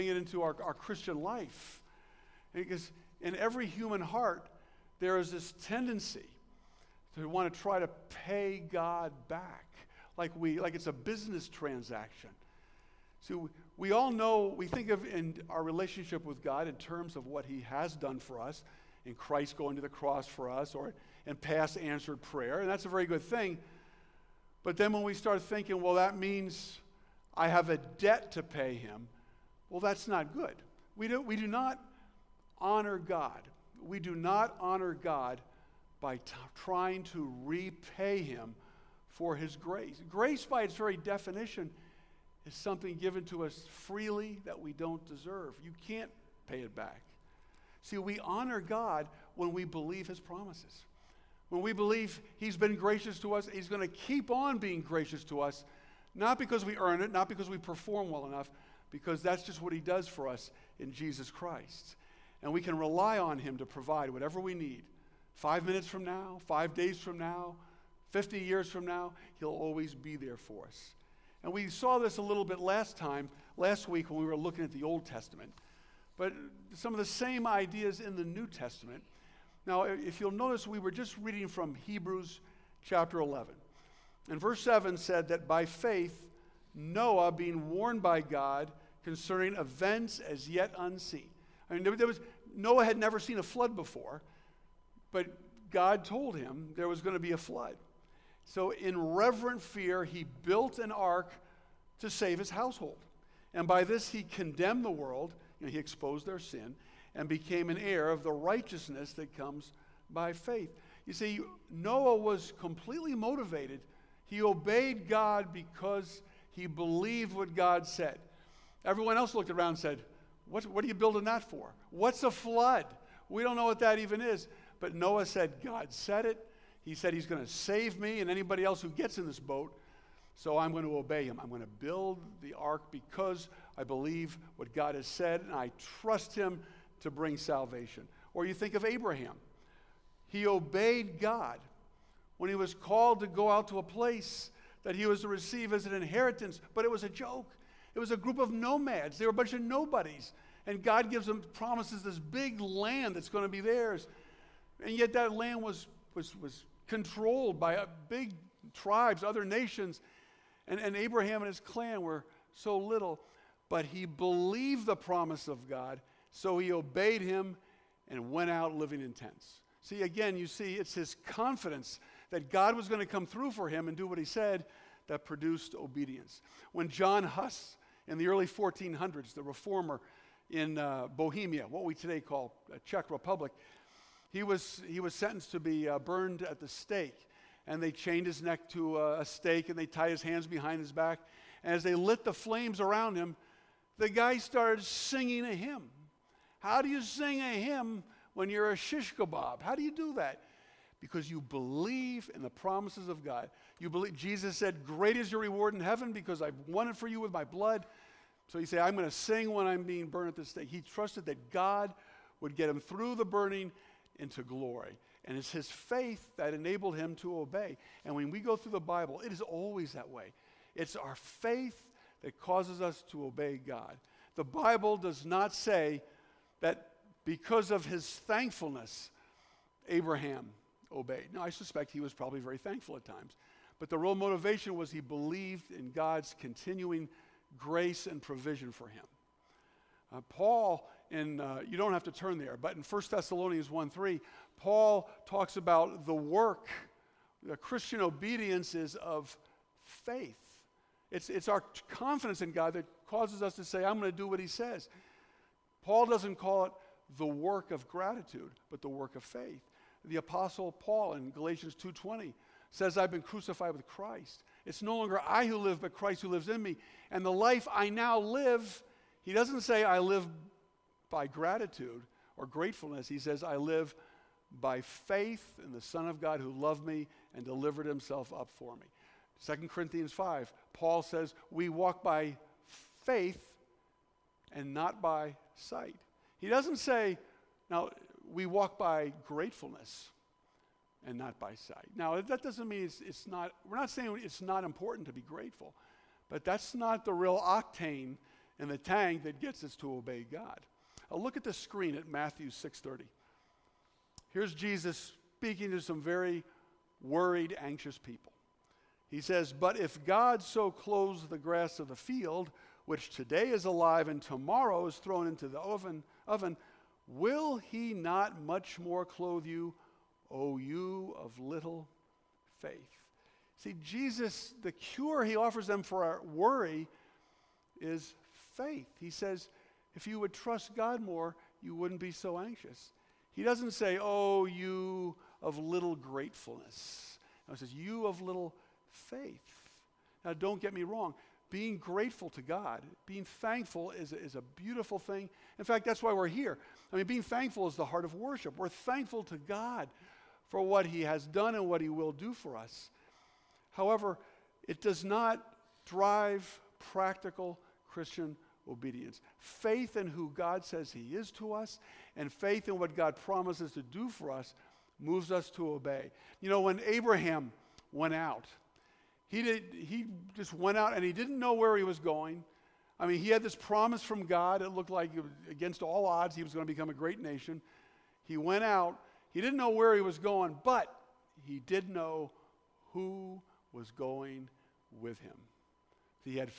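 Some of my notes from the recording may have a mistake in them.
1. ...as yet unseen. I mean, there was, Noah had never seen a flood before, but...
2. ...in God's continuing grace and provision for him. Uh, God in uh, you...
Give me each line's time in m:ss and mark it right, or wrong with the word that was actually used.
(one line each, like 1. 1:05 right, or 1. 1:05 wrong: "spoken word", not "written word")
1. 1:30 right
2. 3:55 wrong: "Paul", not "God".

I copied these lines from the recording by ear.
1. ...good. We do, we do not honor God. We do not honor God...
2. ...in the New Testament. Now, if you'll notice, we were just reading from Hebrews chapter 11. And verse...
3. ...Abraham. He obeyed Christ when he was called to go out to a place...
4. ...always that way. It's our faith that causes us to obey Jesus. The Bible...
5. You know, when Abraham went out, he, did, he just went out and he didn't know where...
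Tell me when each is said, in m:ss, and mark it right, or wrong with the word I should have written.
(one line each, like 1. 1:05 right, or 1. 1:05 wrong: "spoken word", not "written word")
1. 0:30 right
2. 1:17 right
3. 2:18 wrong: "God", not "Christ"
4. 3:39 wrong: "God", not "Jesus"
5. 6:06 right.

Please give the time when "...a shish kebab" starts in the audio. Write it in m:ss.
3:18.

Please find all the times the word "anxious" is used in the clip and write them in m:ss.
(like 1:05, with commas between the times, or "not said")
5:07, 5:32.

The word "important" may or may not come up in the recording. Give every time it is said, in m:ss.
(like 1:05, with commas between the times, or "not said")
4:54.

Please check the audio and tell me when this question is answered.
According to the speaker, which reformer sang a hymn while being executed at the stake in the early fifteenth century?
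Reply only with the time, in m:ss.
2:56.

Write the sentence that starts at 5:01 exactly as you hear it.
Now uh, look at the screen at Matthew 6:30.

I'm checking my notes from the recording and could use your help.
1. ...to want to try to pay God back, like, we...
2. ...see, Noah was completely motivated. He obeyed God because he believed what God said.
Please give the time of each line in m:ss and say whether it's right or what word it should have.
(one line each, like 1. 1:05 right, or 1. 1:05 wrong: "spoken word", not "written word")
1. 0:07 right
2. 1:51 right.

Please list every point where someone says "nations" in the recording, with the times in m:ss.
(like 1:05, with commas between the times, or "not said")
2:39, 6:17.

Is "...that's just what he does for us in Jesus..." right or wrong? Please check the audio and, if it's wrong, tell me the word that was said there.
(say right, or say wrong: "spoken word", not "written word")
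right.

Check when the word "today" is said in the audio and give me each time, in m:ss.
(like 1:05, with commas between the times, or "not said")
3:01, 5:13.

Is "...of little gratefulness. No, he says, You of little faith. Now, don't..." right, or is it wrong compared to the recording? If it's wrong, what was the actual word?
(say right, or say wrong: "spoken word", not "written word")
right.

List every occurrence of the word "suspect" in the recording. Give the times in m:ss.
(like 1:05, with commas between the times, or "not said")
3:51.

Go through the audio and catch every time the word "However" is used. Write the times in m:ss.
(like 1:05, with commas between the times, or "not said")
5:53.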